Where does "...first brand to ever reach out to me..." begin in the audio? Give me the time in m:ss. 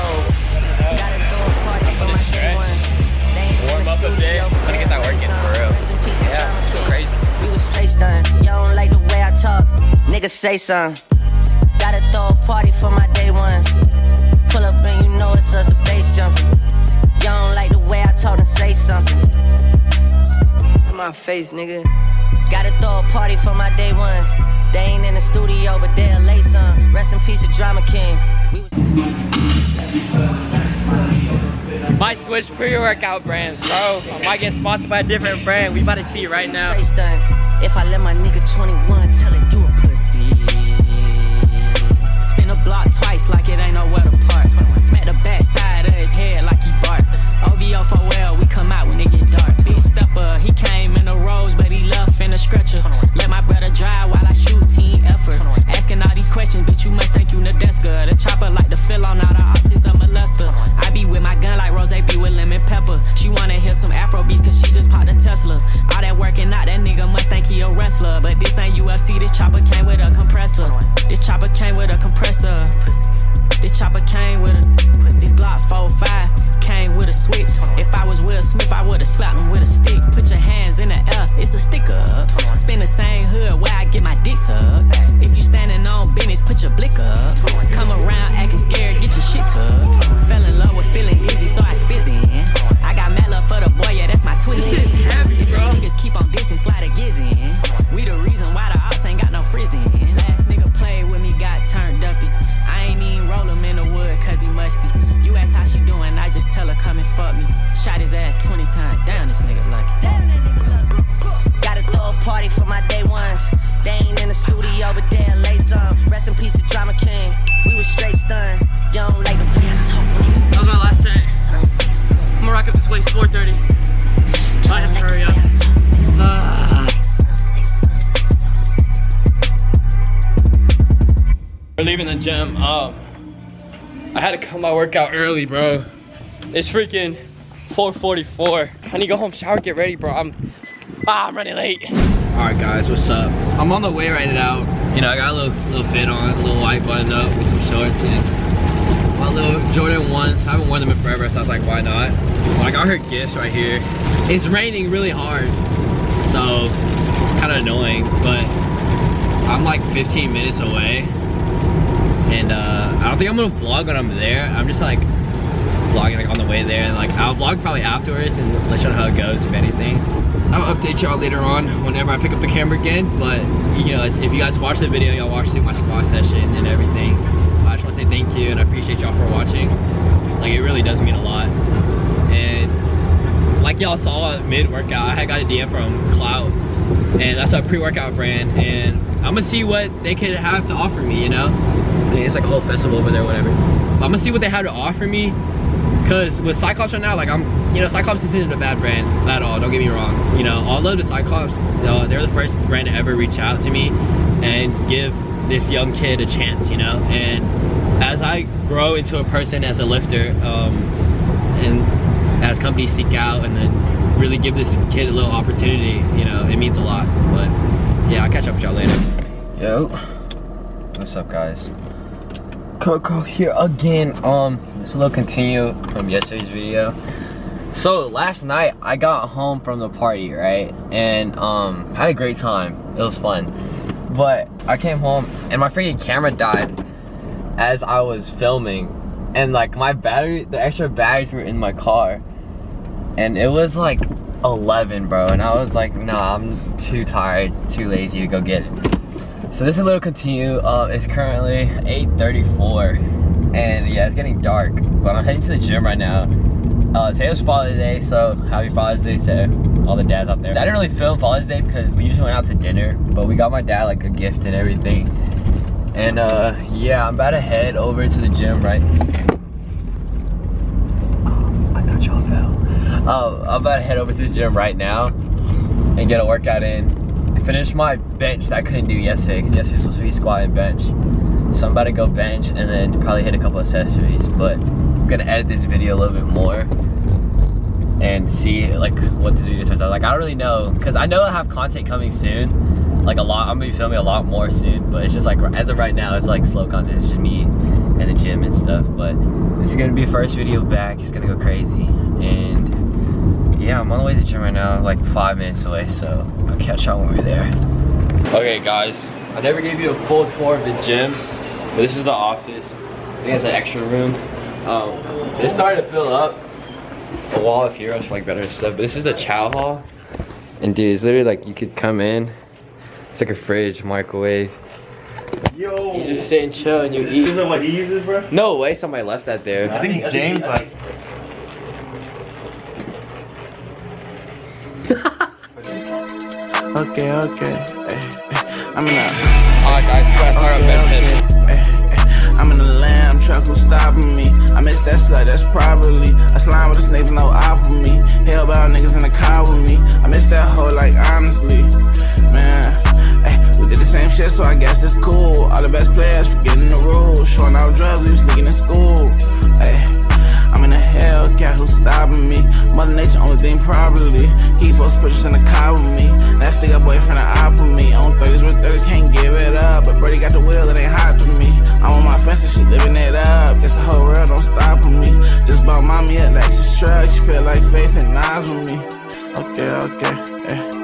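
3:22.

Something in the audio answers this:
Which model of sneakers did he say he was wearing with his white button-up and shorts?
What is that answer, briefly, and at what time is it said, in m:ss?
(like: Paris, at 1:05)
Jordan 1s, at 2:29.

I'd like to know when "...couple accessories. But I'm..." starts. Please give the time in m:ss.
4:43.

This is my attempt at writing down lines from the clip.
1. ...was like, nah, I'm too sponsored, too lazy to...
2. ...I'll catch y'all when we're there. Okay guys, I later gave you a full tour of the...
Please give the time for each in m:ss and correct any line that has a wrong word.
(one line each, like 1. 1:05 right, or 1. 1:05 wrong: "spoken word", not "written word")
1. 4:05 wrong: "tired", not "sponsored"
2. 5:06 wrong: "never", not "later".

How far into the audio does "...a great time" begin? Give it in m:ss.
3:52.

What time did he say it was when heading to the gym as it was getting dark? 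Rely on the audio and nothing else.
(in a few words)
8:34.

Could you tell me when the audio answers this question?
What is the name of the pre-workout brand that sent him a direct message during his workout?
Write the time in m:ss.
3:06.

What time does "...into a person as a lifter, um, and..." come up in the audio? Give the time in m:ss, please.
3:28.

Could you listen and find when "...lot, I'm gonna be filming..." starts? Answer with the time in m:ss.
4:53.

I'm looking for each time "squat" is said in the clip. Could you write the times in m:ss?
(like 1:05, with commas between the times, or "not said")
2:55, 4:40.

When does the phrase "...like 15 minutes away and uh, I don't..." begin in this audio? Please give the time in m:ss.
2:39.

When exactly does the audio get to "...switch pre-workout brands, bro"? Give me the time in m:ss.
0:32.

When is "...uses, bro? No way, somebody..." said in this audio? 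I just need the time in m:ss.
5:27.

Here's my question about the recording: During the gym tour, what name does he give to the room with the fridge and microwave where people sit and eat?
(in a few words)
chow hall.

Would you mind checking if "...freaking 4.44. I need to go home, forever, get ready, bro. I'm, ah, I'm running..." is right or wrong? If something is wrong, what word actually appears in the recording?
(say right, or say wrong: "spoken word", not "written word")
wrong: "shower", not "forever".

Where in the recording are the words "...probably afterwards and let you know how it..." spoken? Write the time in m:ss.
2:47.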